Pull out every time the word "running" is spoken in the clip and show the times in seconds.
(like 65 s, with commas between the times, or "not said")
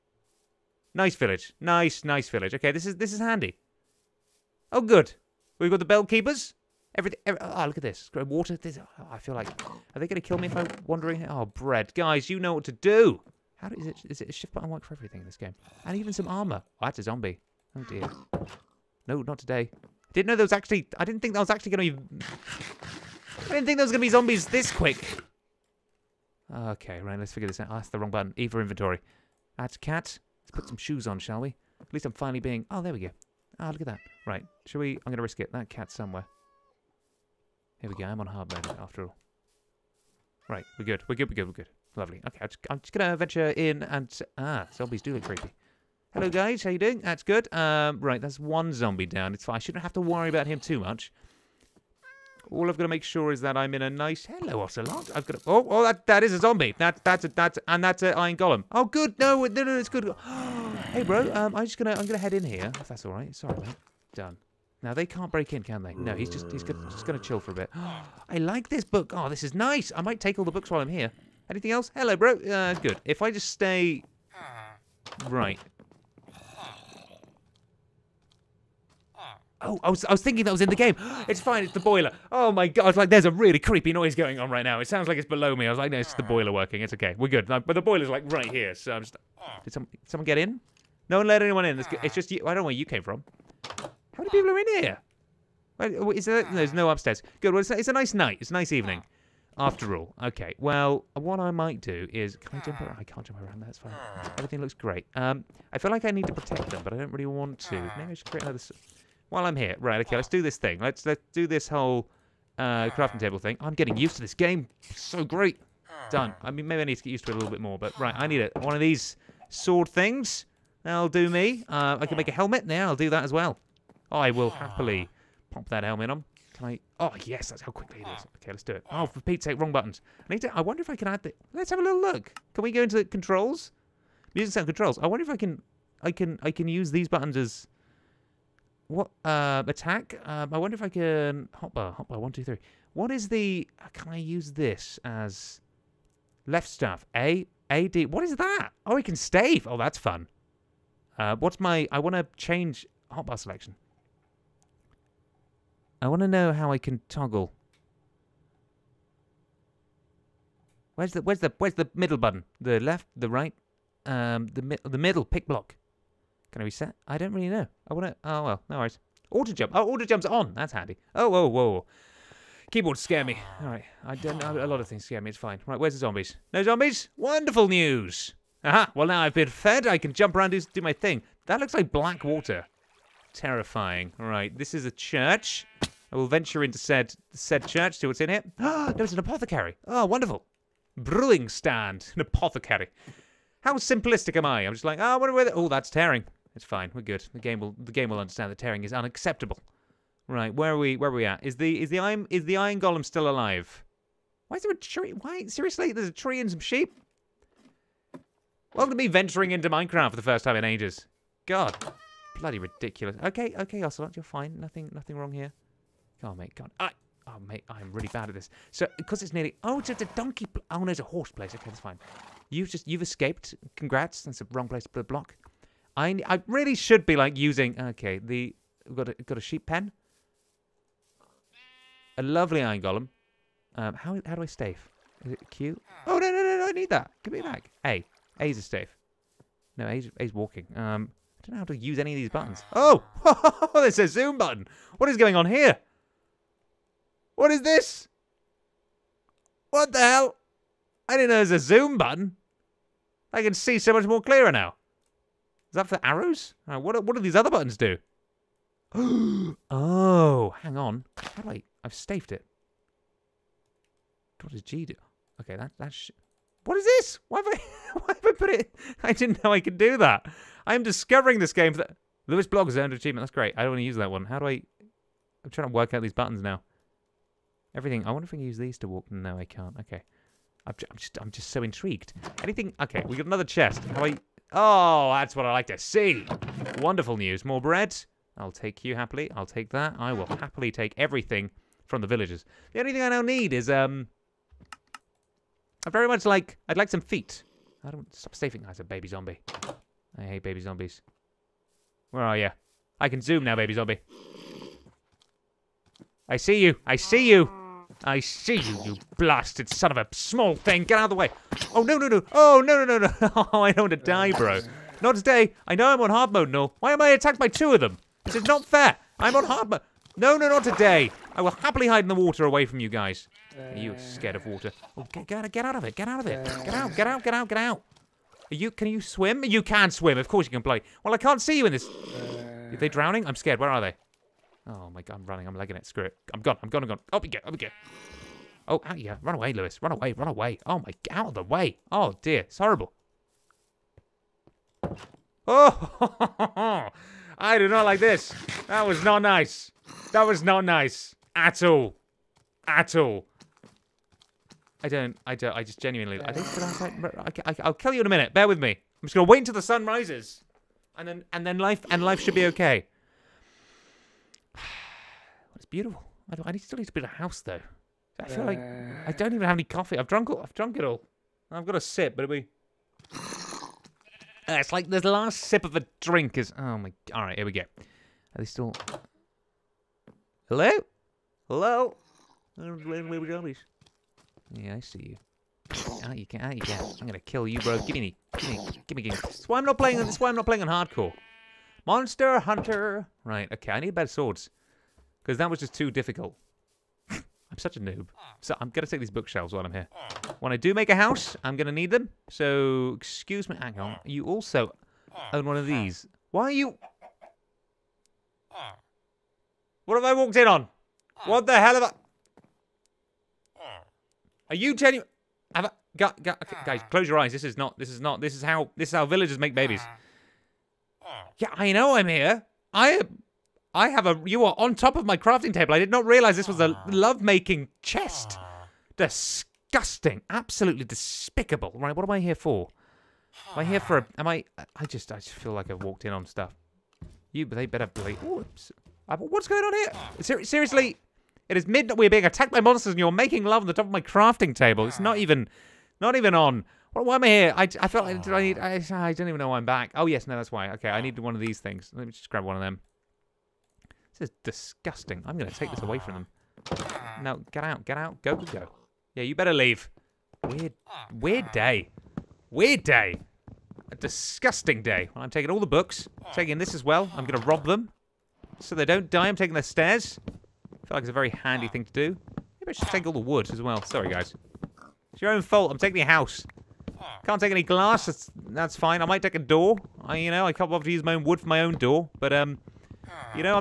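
335 s.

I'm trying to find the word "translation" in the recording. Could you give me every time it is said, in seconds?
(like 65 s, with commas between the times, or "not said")
not said.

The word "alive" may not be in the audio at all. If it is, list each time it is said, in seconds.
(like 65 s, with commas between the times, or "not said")
203 s.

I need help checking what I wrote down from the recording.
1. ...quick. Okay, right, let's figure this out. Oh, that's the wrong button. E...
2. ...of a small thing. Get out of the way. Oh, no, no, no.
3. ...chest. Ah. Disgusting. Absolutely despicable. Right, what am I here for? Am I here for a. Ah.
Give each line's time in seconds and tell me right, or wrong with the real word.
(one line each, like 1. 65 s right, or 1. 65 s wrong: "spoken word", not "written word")
1. 24 s right
2. 309 s right
3. 427 s right.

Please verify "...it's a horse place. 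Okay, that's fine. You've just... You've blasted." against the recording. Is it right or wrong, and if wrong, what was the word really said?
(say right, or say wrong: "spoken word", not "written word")
wrong: "escaped", not "blasted".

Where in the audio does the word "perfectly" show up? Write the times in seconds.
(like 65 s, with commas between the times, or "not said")
not said.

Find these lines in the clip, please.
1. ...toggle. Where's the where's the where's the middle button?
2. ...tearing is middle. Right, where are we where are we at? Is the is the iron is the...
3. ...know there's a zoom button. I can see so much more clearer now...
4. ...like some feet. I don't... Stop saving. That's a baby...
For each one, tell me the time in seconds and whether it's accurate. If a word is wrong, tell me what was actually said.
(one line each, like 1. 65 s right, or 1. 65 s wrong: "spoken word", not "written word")
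1. 157 s right
2. 198 s wrong: "unacceptable", not "middle"
3. 251 s right
4. 296 s right.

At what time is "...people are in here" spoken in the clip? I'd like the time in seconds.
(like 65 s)
94 s.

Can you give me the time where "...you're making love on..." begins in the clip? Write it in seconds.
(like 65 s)
442 s.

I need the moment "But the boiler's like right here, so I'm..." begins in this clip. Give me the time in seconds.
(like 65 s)
87 s.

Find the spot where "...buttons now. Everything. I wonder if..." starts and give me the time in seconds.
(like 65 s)
276 s.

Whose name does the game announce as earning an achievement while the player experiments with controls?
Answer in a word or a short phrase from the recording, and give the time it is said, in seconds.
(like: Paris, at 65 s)
Lewis Blog, at 272 s.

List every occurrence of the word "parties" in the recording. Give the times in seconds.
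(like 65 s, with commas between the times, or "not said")
not said.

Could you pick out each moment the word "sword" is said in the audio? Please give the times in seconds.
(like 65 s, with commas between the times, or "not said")
119 s, 394 s.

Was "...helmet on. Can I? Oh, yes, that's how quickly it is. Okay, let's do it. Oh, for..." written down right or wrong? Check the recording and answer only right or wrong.
right.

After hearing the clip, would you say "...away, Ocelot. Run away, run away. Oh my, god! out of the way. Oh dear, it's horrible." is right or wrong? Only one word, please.
wrong.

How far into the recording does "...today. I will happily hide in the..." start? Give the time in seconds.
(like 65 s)
320 s.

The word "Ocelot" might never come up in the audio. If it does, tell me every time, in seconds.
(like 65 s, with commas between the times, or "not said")
54 s, 213 s.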